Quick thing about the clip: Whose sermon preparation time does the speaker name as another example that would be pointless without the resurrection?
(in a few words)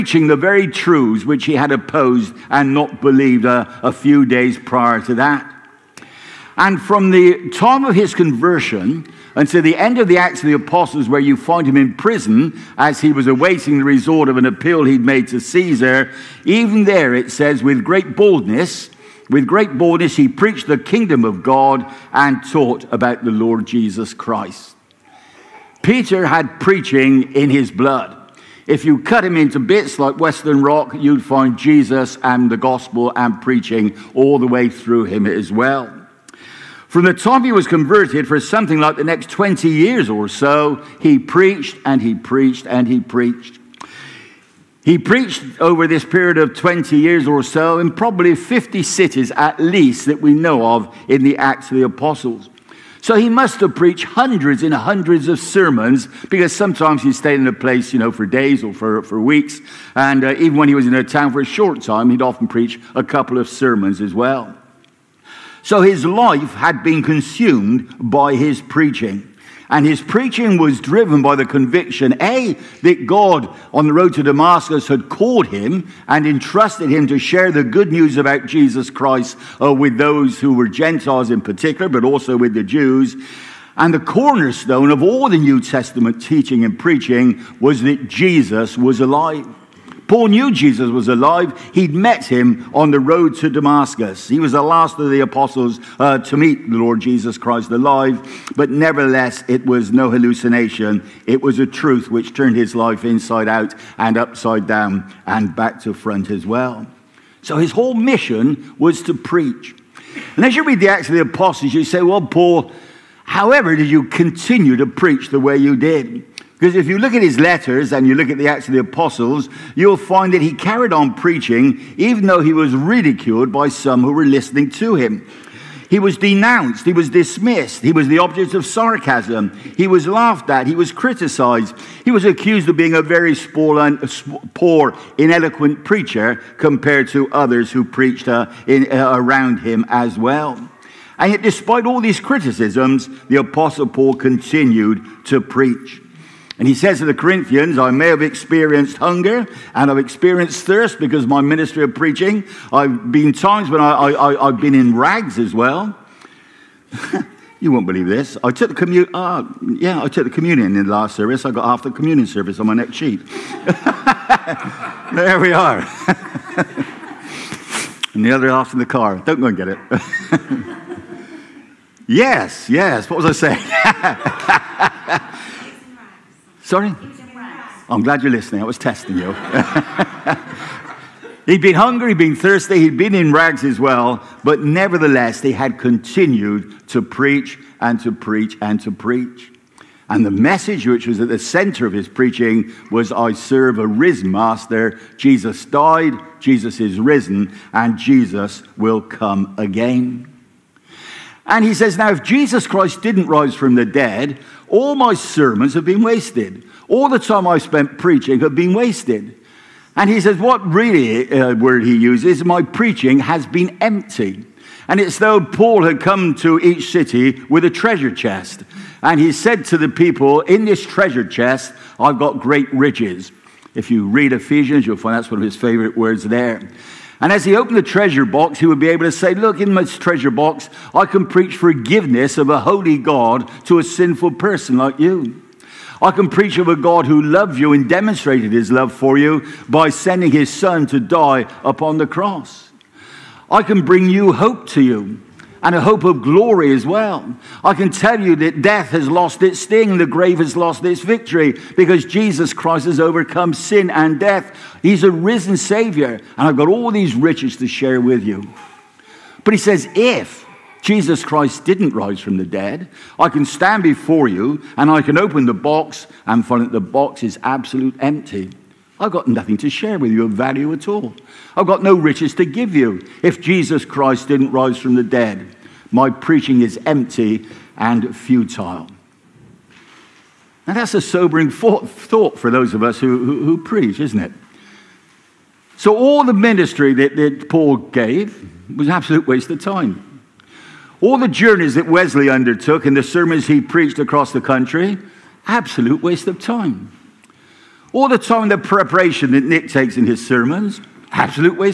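Nick.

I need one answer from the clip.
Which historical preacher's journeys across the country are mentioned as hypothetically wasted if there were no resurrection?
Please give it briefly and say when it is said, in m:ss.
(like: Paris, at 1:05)
Wesley, at 4:51.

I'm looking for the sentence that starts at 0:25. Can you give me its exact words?
Peter had preaching in his blood.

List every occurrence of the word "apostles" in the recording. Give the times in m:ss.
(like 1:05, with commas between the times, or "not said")
0:10, 0:51, 1:35, 1:51, 1:58, 2:23.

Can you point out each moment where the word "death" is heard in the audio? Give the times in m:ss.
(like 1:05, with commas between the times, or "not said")
4:08, 4:14.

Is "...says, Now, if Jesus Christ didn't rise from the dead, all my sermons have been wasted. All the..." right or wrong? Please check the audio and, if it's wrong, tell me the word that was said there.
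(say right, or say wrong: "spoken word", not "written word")
right.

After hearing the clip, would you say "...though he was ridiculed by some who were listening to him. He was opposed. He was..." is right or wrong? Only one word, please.
wrong.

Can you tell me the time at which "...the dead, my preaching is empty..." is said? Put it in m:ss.
4:34.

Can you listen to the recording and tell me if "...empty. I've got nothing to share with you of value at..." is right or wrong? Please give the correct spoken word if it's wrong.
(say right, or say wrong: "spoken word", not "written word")
right.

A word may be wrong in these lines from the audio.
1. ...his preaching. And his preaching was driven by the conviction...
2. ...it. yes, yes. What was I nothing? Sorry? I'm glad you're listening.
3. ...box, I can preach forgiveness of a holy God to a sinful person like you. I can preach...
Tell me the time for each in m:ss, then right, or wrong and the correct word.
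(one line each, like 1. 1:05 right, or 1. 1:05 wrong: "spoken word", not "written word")
1. 1:08 right
2. 2:49 wrong: "saying", not "nothing"
3. 3:50 right.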